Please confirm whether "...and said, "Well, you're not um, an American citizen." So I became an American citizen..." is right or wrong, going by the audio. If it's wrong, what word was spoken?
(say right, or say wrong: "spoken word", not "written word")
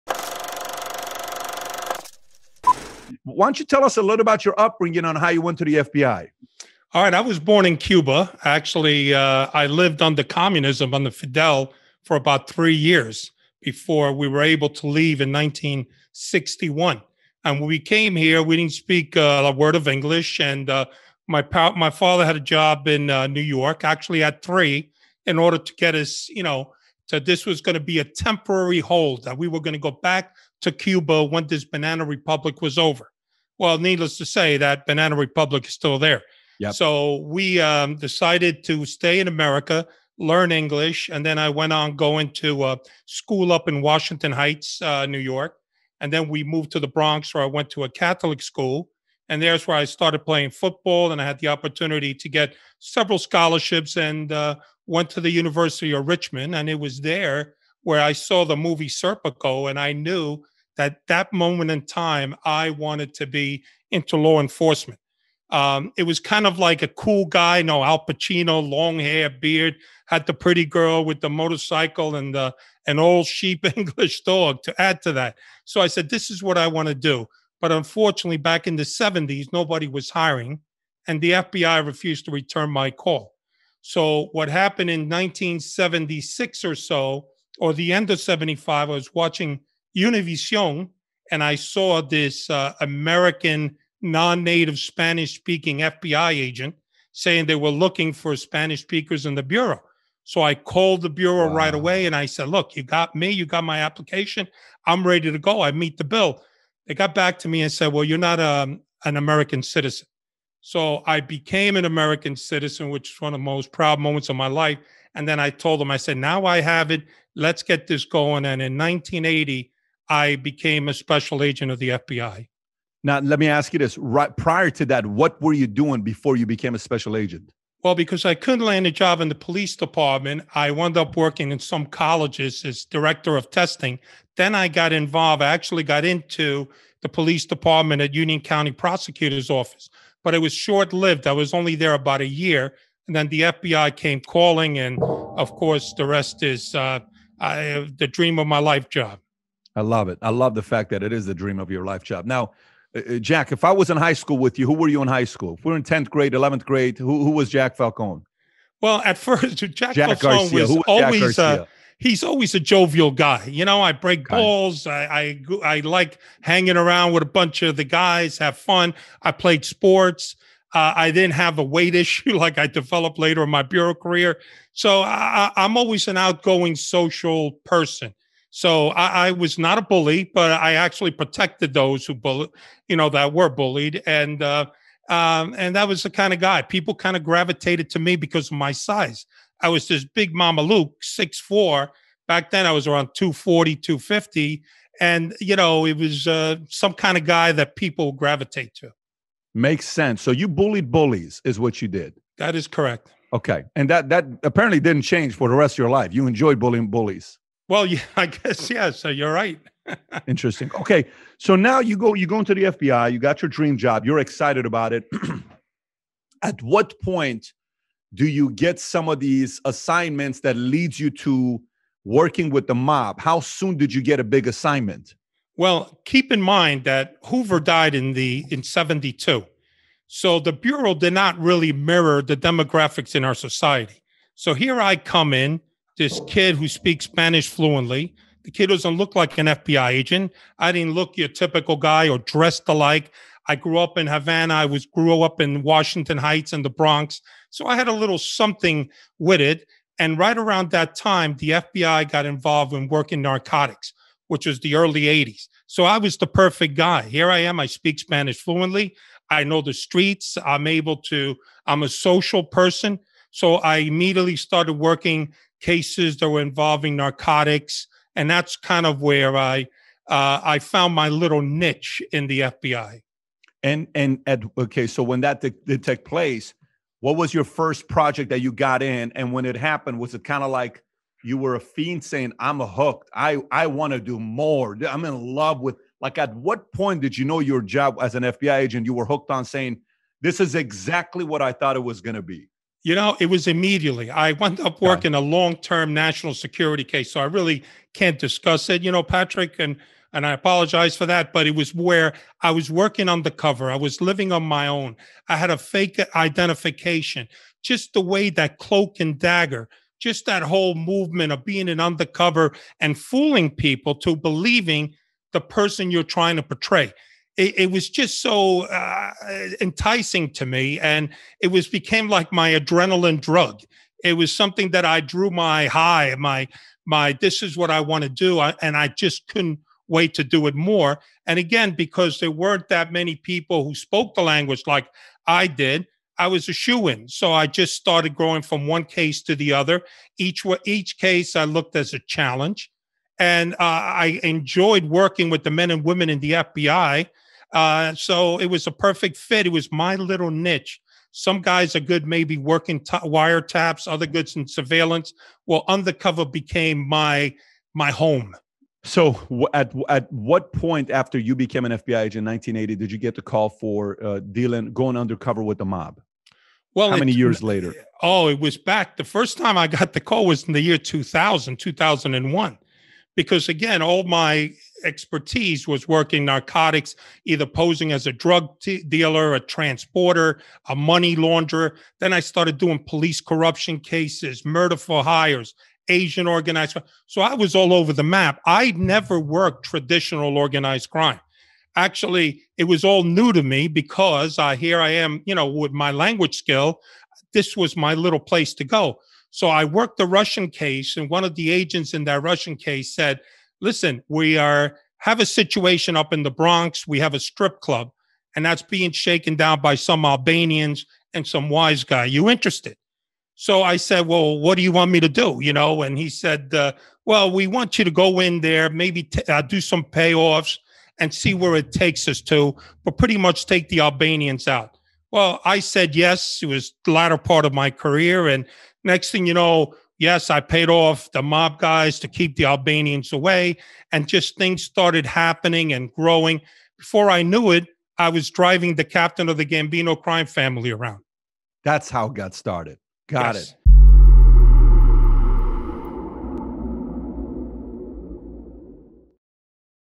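right.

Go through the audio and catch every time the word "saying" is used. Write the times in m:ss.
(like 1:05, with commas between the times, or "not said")
1:37, 4:42, 4:49.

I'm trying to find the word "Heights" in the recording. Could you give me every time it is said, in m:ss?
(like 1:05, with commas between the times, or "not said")
0:44, 4:06.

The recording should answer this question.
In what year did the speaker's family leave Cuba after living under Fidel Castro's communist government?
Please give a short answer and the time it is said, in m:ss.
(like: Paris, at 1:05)
1961, at 0:15.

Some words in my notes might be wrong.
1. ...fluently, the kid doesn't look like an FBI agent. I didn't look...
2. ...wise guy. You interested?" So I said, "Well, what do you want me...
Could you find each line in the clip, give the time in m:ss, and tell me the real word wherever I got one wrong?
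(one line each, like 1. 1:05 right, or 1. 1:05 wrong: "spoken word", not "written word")
1. 3:57 right
2. 6:51 right.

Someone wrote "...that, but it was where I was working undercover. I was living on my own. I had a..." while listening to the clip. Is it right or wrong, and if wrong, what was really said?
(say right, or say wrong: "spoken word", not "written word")
right.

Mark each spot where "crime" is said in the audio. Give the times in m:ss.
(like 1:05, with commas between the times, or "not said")
6:26, 6:30, 7:20.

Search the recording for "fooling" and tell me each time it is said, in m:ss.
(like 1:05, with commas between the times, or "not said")
5:12.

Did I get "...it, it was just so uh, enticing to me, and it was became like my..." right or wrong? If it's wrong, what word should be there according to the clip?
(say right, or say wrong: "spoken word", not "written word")
right.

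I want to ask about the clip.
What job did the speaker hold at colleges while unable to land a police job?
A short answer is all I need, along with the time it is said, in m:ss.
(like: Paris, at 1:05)
Director of testing, at 2:12.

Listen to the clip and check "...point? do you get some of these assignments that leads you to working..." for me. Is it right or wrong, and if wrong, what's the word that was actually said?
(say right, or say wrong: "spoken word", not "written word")
right.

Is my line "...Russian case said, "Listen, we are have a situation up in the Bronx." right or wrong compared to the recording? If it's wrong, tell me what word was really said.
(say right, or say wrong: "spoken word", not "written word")
right.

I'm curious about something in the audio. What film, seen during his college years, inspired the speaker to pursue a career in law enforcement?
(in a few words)
Serpico.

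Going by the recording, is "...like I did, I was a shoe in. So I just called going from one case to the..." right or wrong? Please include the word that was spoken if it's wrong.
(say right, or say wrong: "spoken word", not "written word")
wrong: "started", not "called".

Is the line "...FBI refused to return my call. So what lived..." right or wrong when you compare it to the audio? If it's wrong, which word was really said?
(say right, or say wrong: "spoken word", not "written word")
wrong: "happened", not "lived".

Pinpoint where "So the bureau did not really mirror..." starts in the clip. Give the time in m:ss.
3:50.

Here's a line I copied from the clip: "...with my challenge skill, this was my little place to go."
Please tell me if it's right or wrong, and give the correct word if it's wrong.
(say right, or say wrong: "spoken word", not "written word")
wrong: "language", not "challenge".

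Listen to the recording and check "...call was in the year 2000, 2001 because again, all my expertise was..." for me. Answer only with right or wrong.
right.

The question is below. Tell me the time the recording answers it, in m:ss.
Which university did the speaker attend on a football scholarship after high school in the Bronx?
0:55.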